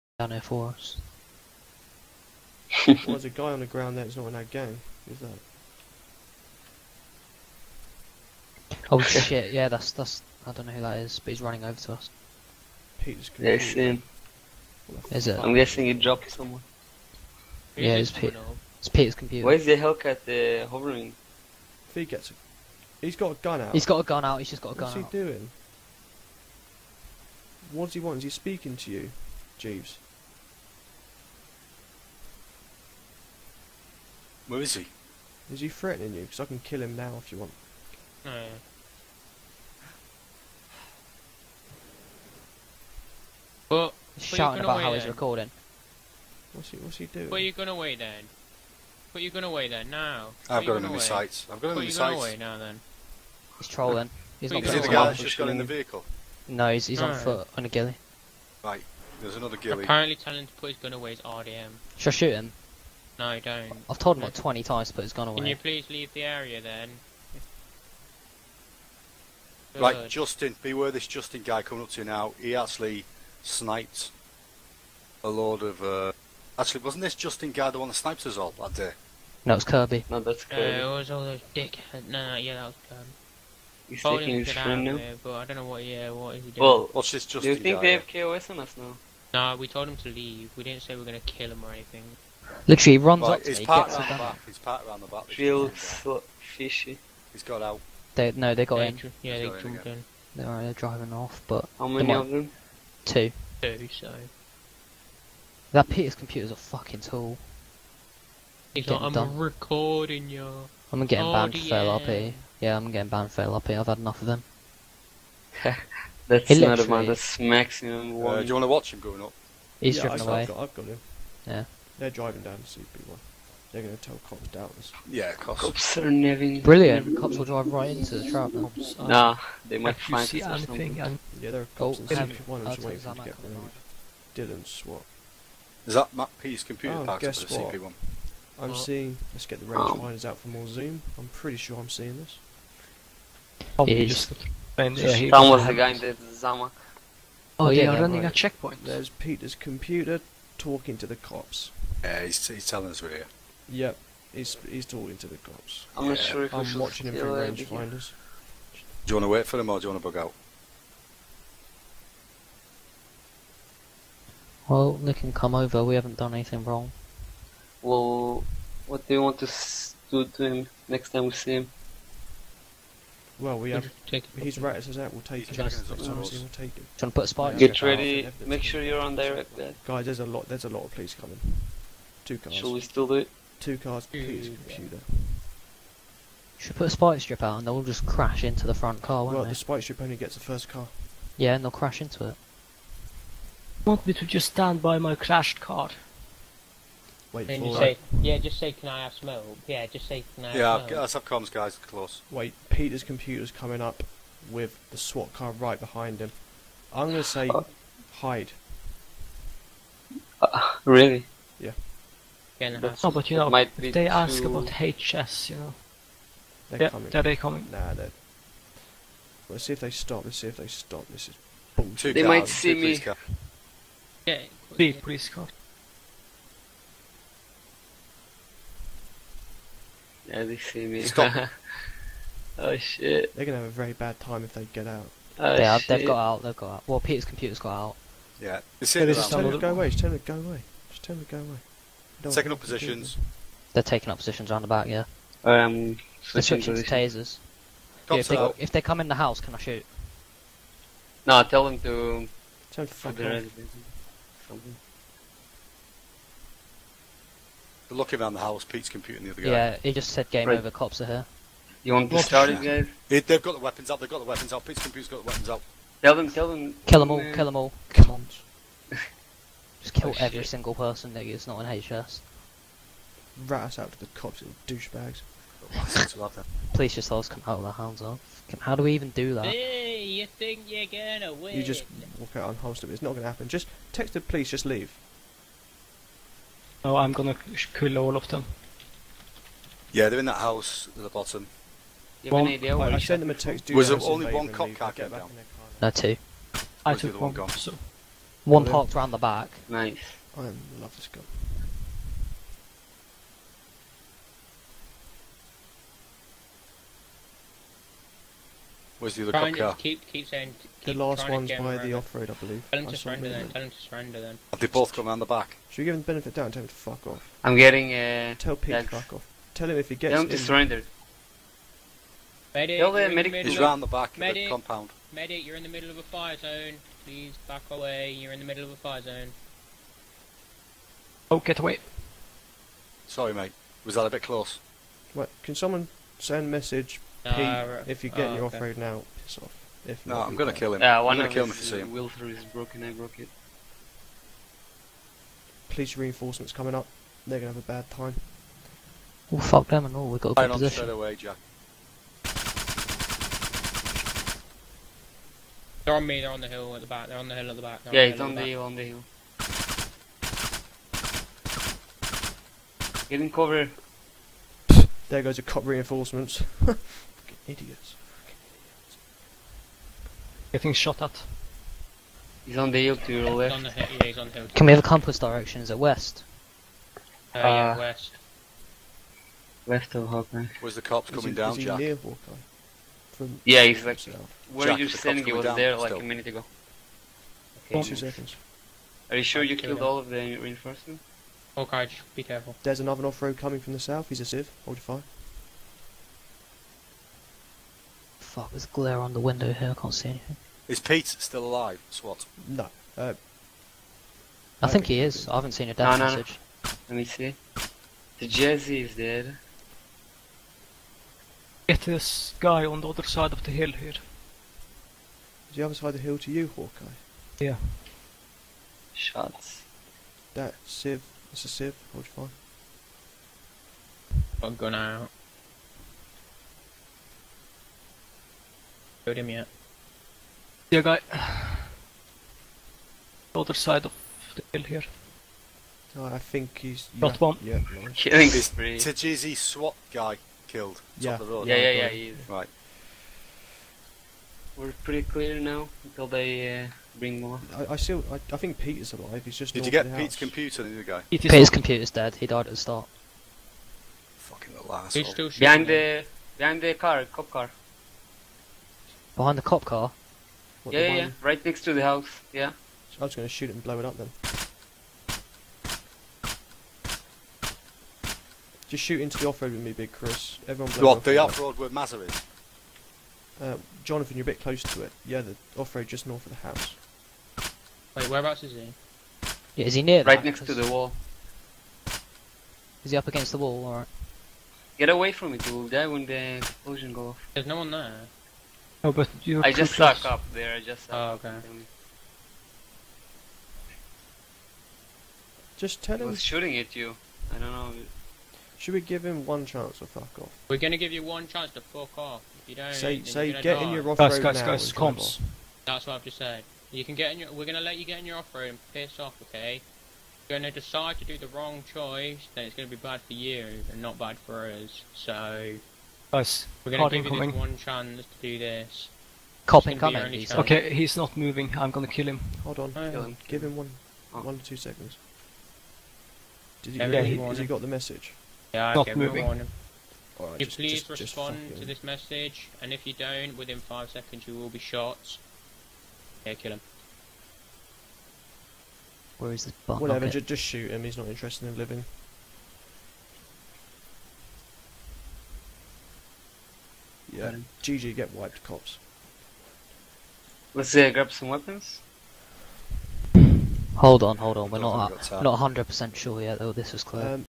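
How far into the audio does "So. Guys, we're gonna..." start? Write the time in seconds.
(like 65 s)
514 s.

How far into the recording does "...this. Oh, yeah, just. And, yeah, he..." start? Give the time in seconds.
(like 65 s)
142 s.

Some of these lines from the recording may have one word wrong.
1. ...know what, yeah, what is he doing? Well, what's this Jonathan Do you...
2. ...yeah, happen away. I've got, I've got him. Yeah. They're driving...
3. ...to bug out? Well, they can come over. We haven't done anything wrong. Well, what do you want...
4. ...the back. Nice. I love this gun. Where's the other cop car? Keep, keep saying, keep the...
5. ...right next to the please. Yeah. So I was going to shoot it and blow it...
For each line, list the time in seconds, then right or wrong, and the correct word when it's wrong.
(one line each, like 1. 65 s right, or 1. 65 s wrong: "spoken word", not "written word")
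1. 85 s wrong: "Justin", not "Jonathan"
2. 119 s wrong: "driven", not "happen"
3. 160 s right
4. 299 s right
5. 461 s wrong: "house", not "please".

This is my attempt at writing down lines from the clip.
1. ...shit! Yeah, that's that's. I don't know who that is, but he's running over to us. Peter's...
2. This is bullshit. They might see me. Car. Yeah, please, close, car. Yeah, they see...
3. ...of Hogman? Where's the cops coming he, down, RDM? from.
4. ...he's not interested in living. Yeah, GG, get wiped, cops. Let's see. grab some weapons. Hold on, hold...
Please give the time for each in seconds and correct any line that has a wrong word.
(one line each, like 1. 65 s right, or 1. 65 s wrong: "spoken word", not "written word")
1. 9 s right
2. 221 s wrong: "please", not "close"
3. 379 s wrong: "Jack", not "RDM"
4. 540 s right.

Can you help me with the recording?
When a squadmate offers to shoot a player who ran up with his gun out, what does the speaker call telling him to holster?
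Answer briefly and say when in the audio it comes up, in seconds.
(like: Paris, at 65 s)
RDM, at 61 s.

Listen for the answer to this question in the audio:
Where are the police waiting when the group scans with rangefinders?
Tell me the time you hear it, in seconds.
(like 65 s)
132 s.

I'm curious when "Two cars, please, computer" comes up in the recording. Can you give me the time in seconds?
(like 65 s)
183 s.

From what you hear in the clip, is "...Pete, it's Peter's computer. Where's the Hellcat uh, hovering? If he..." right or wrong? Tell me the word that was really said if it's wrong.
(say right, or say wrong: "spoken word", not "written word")
right.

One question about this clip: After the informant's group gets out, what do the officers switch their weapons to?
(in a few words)
tasers.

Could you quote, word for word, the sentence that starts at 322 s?
Medic, the He's round the back medic, of the compound.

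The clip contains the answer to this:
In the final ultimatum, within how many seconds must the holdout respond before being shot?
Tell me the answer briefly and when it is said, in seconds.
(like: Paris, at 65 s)
5, at 533 s.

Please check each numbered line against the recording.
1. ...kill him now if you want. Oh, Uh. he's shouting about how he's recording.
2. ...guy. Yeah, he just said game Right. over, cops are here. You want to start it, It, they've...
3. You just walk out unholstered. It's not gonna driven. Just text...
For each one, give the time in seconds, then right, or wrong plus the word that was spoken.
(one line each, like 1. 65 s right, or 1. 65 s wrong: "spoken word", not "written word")
1. 36 s right
2. 259 s right
3. 281 s wrong: "happen", not "driven".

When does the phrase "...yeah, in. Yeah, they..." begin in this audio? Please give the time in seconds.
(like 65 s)
98 s.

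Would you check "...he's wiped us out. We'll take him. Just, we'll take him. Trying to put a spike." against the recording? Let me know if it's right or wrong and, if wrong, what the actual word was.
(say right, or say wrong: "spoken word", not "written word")
wrong: "ratted", not "wiped".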